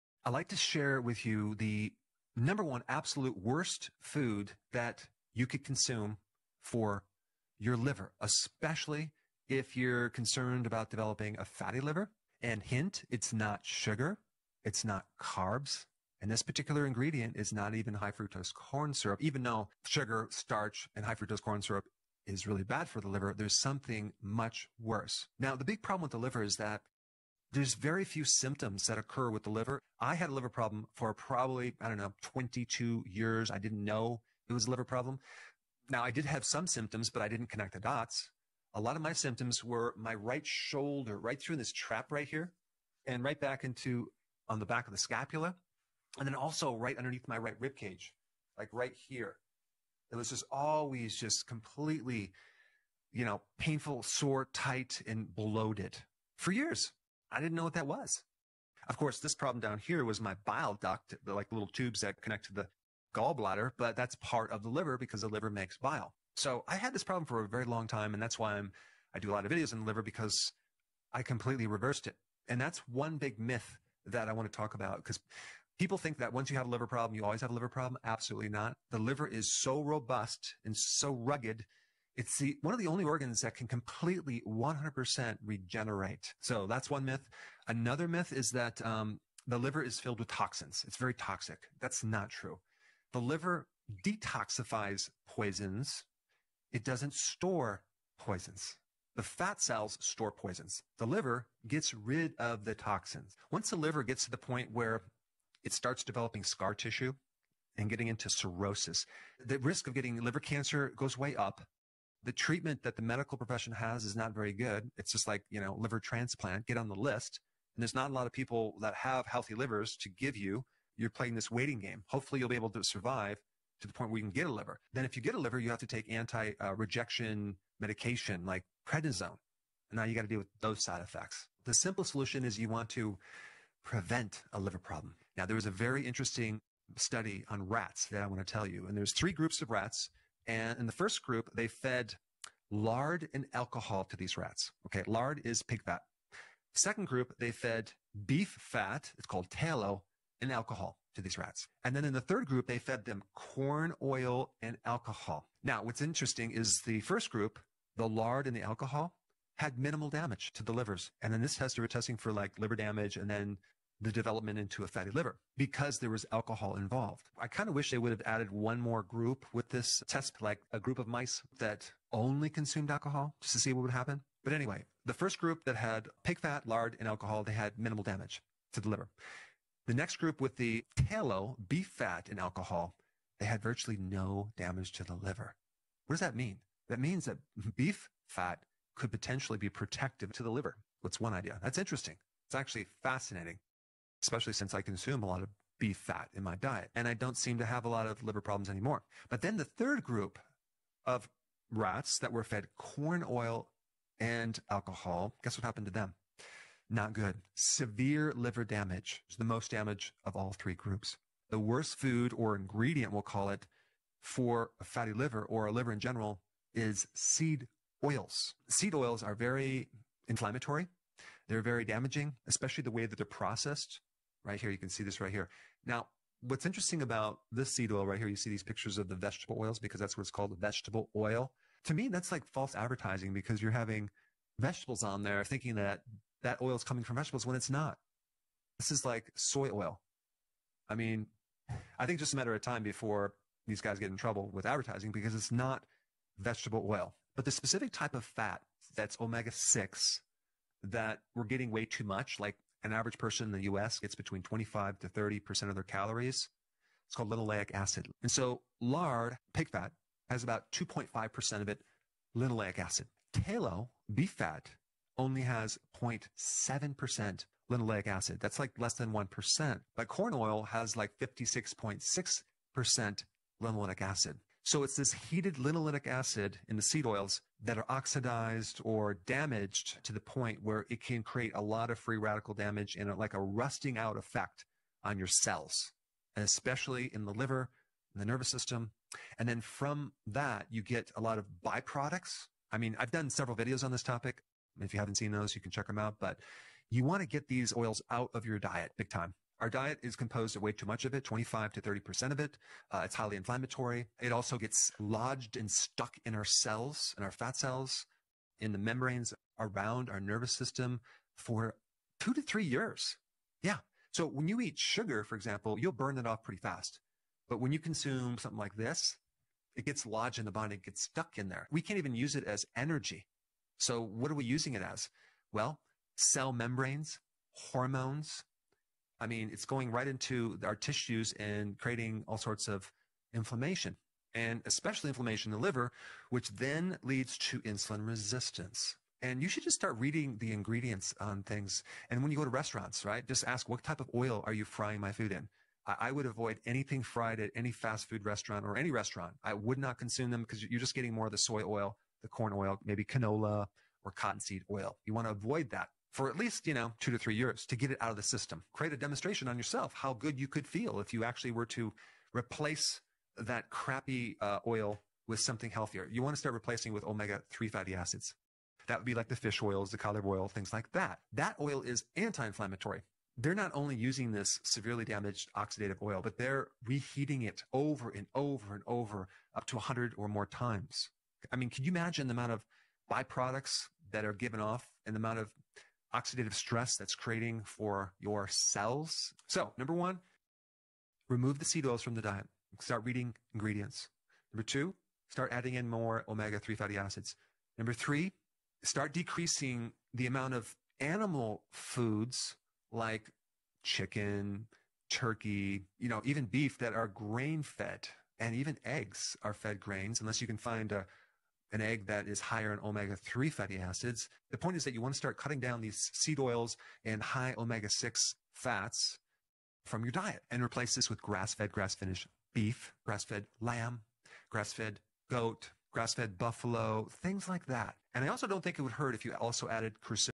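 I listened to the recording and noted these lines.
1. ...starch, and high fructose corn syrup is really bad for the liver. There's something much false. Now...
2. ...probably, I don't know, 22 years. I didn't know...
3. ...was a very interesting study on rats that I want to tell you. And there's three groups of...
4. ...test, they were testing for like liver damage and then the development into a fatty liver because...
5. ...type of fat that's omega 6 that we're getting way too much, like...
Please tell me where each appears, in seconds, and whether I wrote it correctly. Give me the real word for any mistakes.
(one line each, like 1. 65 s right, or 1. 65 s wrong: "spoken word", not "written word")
1. 20 s wrong: "worse", not "false"
2. 31 s right
3. 135 s right
4. 161 s right
5. 247 s right.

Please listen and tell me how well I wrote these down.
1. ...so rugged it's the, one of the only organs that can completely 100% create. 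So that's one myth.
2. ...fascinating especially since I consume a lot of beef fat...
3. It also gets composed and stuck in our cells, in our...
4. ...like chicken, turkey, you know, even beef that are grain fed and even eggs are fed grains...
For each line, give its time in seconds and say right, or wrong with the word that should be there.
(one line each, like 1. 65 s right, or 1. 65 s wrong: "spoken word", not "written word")
1. 80 s wrong: "regenerate", not "create"
2. 193 s right
3. 304 s wrong: "lodged", not "composed"
4. 402 s right.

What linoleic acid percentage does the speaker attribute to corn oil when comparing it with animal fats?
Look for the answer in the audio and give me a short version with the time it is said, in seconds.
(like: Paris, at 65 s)
56.6%, at 271 s.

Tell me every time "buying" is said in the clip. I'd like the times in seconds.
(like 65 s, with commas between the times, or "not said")
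not said.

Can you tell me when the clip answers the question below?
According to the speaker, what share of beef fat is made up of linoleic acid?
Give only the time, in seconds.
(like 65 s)
266 s.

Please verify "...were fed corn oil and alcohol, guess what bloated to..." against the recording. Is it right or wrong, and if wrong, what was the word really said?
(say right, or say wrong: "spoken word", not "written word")
wrong: "happened", not "bloated".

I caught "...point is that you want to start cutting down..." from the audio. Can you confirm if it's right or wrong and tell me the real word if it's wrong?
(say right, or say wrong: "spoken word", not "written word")
right.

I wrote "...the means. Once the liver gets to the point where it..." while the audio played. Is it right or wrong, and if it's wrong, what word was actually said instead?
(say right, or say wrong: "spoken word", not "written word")
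wrong: "toxins", not "means".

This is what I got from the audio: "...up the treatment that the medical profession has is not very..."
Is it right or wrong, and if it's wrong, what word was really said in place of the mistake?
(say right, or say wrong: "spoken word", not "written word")
right.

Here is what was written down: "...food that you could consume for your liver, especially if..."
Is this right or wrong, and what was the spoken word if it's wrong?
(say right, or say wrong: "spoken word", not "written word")
right.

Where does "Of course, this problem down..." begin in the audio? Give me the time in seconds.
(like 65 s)
58 s.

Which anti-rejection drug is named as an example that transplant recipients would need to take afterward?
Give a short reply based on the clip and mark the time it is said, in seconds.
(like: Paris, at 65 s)
prednisone, at 128 s.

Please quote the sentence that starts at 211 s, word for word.
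The worst food or ingredient, we'll call it, for a fatty liver or a liver in general is seed oils.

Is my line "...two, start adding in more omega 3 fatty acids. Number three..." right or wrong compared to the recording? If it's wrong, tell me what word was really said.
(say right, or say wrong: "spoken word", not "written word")
right.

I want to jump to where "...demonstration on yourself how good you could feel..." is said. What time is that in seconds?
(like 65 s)
358 s.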